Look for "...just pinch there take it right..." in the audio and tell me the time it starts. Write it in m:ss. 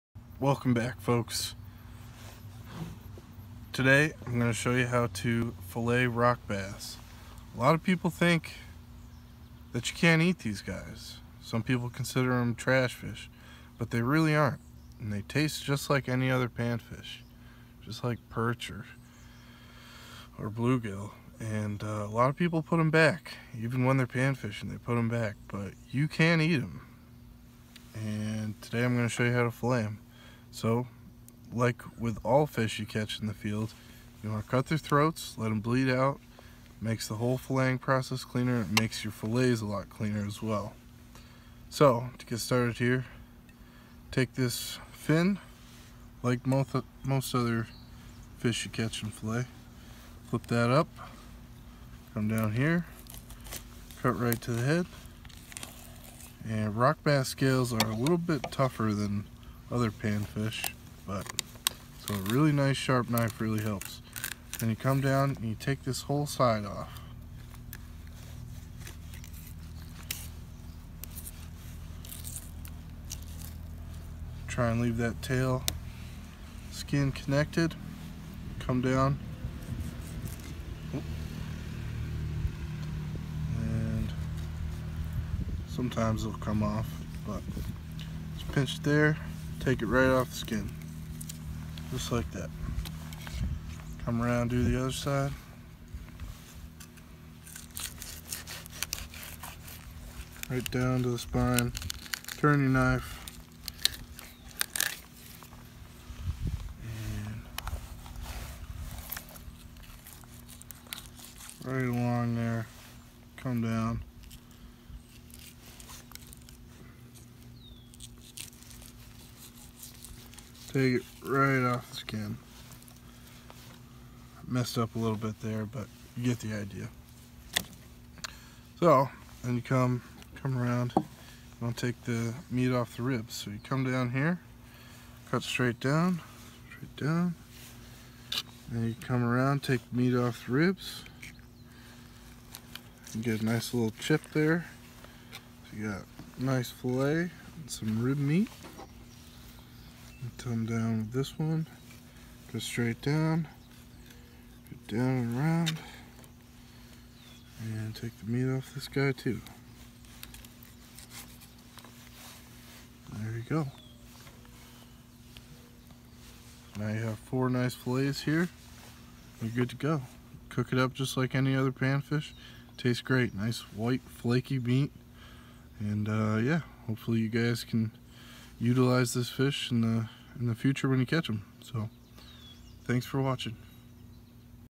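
1:28.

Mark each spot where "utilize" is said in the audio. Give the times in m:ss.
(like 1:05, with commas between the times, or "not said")
2:58.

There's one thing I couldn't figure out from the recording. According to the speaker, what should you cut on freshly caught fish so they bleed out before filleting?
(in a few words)
their throats.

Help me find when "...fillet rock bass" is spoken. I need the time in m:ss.
0:05.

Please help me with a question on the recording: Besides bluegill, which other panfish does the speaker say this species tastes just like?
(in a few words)
perch.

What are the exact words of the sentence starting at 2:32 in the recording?
Go straight down, go down and around, and take the meat off this guy too.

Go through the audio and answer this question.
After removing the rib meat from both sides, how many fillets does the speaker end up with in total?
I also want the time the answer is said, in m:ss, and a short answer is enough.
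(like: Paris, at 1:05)
4, at 2:47.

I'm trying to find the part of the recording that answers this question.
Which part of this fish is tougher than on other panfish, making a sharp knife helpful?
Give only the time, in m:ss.
0:57.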